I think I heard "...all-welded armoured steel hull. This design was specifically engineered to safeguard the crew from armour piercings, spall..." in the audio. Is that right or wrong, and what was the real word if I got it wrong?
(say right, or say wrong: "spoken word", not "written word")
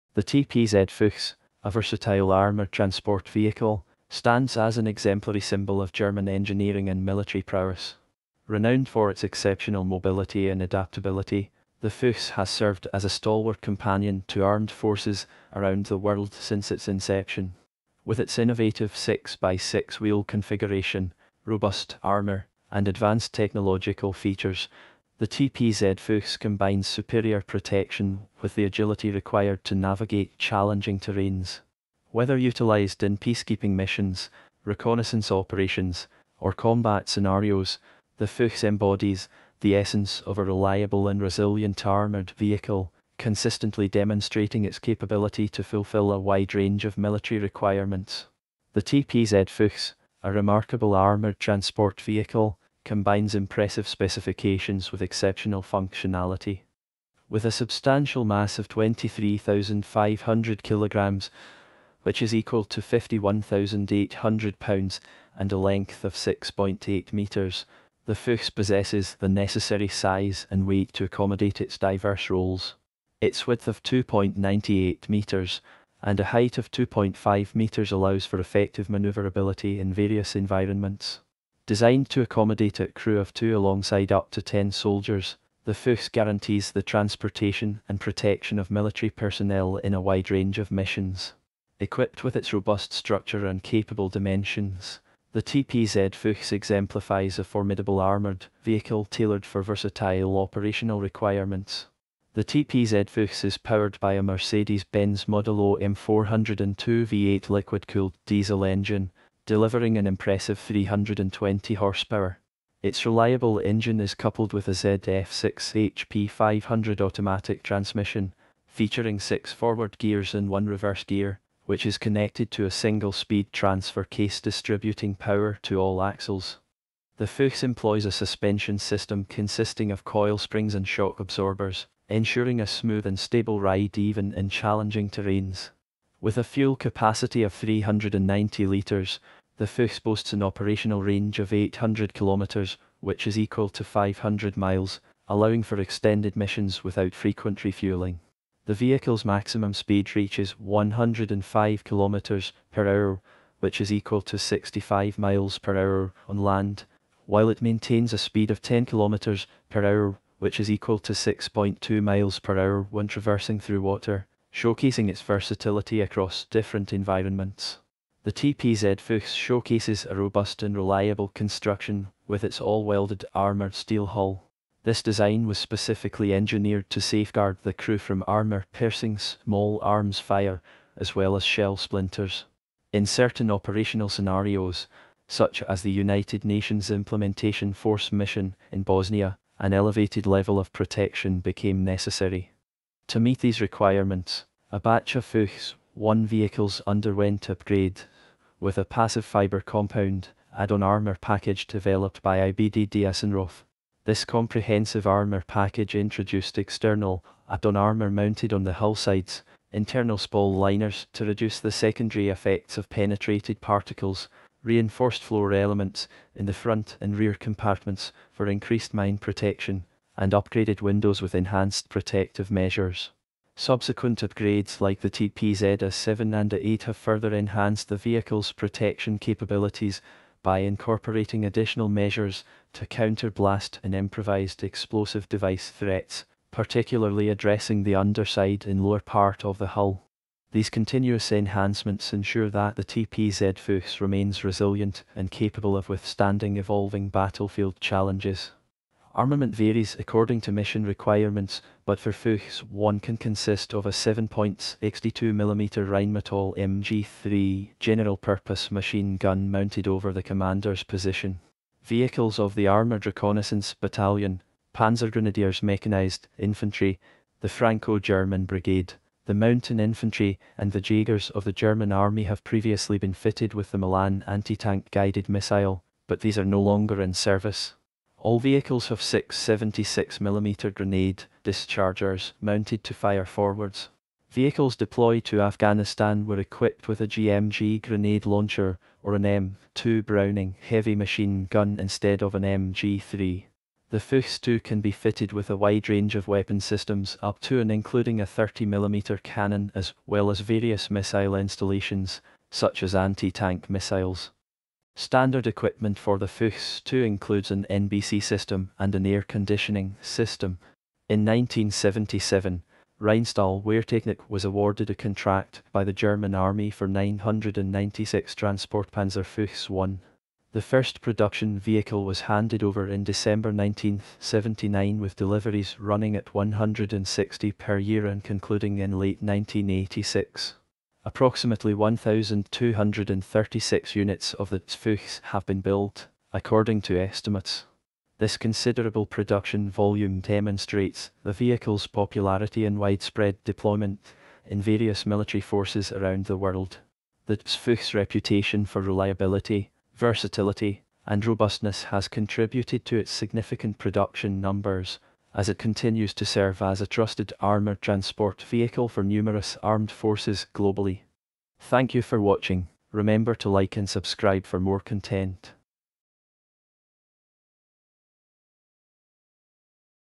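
wrong: "small", not "spall".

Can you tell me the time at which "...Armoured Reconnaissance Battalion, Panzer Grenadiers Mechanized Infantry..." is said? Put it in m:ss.
4:22.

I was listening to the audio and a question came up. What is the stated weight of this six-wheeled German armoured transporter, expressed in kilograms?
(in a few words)
23,500 kilograms.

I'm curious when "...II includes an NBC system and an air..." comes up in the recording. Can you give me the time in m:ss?
5:06.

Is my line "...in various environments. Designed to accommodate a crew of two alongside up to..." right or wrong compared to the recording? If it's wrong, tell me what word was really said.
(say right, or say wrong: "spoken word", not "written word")
right.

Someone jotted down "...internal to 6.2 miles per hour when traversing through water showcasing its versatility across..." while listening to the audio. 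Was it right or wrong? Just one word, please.
wrong.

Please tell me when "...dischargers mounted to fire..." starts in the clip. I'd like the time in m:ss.
4:41.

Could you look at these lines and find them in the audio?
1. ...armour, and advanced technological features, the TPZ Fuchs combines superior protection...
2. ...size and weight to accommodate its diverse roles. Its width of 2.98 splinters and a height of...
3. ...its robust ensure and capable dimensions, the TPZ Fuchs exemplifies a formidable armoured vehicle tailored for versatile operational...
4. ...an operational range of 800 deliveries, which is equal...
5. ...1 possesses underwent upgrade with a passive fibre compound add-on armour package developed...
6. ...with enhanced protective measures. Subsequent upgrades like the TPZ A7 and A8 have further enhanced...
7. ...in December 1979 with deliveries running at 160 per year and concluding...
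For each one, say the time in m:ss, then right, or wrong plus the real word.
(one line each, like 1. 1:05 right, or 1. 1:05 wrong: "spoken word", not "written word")
1. 0:22 right
2. 1:09 wrong: "meters", not "splinters"
3. 1:32 wrong: "structure", not "ensure"
4. 2:20 wrong: "kilometres", not "deliveries"
5. 3:15 wrong: "vehicles", not "possesses"
6. 3:41 right
7. 5:22 right.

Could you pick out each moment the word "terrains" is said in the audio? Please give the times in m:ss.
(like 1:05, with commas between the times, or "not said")
0:30, 2:15.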